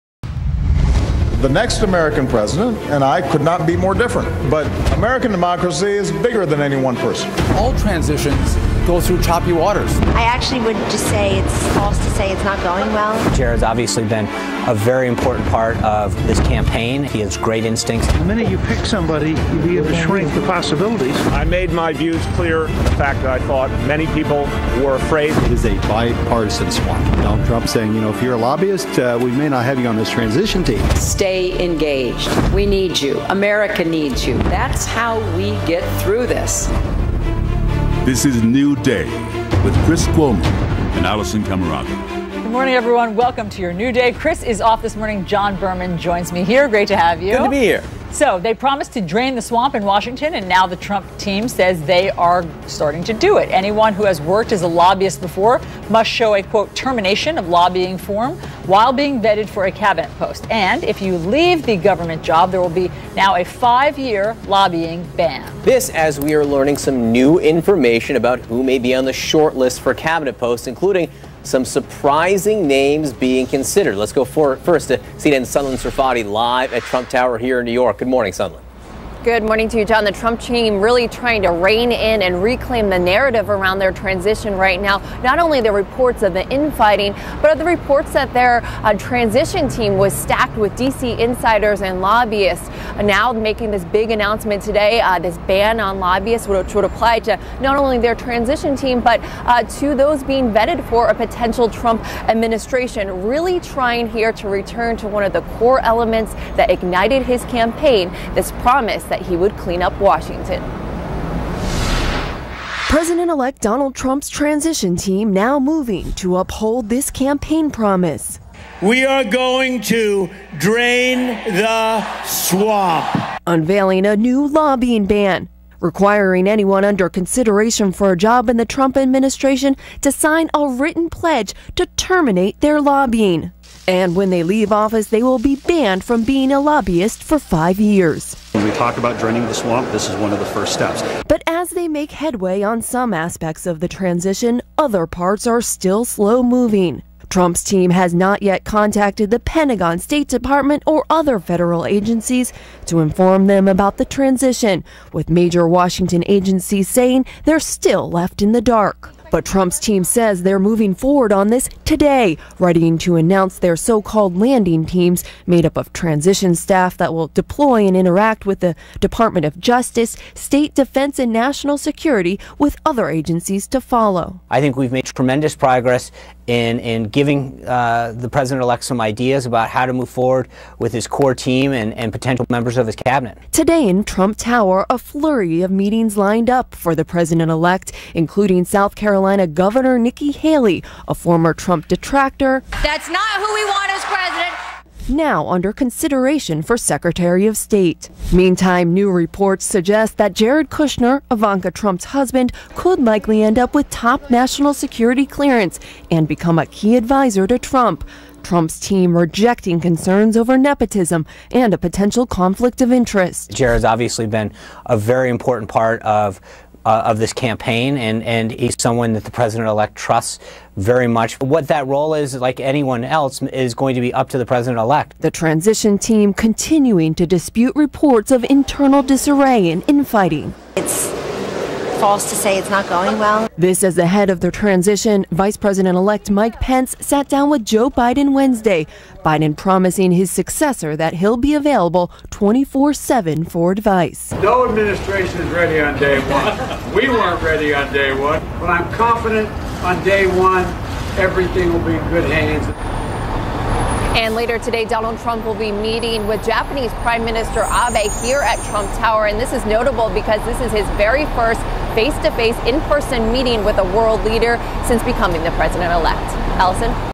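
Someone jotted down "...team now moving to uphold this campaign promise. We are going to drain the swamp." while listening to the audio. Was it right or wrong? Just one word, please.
right.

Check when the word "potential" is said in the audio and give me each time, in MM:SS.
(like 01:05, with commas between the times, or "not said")
01:41, 03:02, 03:31.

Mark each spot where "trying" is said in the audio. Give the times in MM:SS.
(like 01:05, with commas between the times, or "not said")
01:21, 01:43.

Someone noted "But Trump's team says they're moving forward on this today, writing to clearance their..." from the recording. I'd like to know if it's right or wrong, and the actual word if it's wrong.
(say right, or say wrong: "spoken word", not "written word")
wrong: "announce", not "clearance".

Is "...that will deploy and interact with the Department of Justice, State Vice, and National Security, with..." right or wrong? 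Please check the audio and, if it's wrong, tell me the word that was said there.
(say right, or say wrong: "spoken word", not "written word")
wrong: "Defense", not "Vice".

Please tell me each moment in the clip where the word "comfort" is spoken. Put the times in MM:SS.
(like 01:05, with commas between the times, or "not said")
not said.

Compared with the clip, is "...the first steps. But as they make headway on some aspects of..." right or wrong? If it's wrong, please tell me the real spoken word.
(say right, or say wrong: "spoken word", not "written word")
right.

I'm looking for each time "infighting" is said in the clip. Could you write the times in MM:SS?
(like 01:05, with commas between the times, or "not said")
01:26, 03:49.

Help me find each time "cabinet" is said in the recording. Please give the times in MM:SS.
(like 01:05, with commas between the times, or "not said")
00:59, 01:09, 03:02.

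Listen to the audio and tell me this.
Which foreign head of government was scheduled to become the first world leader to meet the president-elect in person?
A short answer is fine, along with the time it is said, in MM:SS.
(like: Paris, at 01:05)
Prime Minister Abe, at 04:16.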